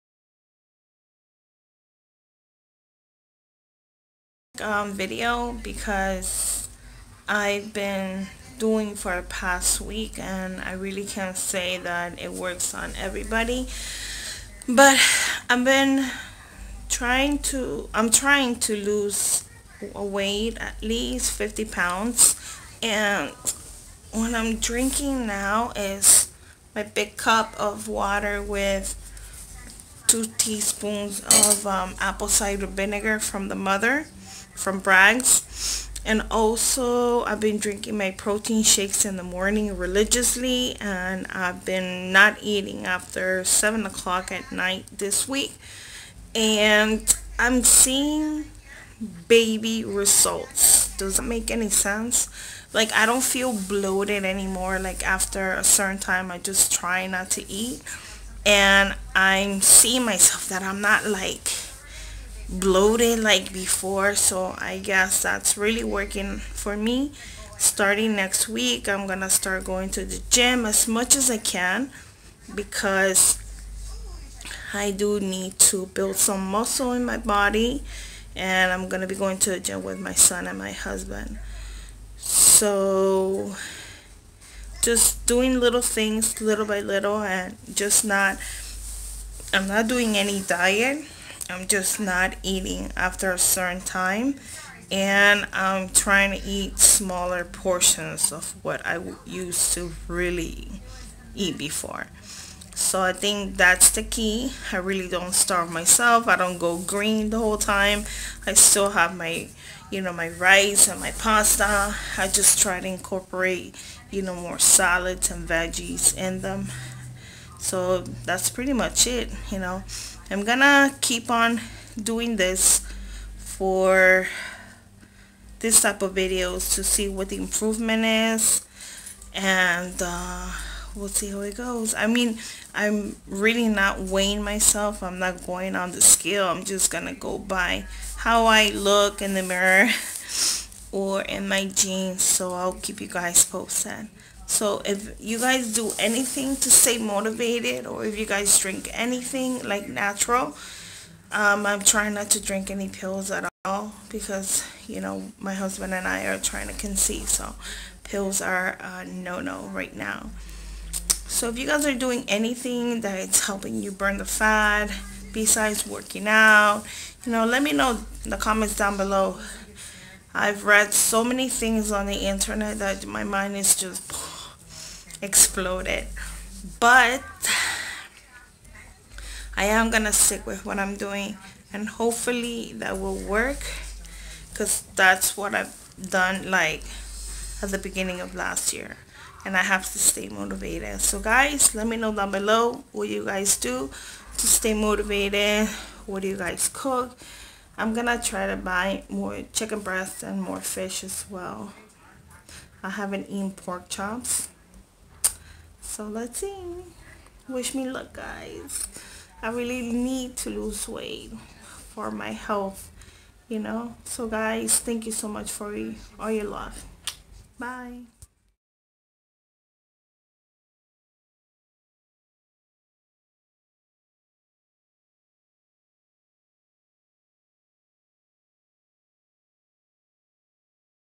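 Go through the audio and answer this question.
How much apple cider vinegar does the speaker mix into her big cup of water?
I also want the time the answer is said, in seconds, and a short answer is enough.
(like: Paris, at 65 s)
2 teaspoons, at 30 s.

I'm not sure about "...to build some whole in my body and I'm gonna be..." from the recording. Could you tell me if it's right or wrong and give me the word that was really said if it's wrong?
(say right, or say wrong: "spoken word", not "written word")
wrong: "muscle", not "whole".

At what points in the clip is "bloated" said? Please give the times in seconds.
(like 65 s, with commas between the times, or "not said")
53 s, 62 s.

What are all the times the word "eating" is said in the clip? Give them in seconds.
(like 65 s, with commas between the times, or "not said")
42 s, 92 s.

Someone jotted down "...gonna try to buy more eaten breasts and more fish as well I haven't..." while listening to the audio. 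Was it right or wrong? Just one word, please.
wrong.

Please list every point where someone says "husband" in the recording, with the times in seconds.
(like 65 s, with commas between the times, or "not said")
80 s, 155 s.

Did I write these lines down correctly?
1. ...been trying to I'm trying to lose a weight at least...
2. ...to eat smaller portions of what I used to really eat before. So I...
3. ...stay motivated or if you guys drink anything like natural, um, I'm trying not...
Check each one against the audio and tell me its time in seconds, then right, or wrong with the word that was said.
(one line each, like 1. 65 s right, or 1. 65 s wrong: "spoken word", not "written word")
1. 15 s right
2. 96 s right
3. 146 s right.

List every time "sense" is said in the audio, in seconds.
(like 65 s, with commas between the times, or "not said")
51 s.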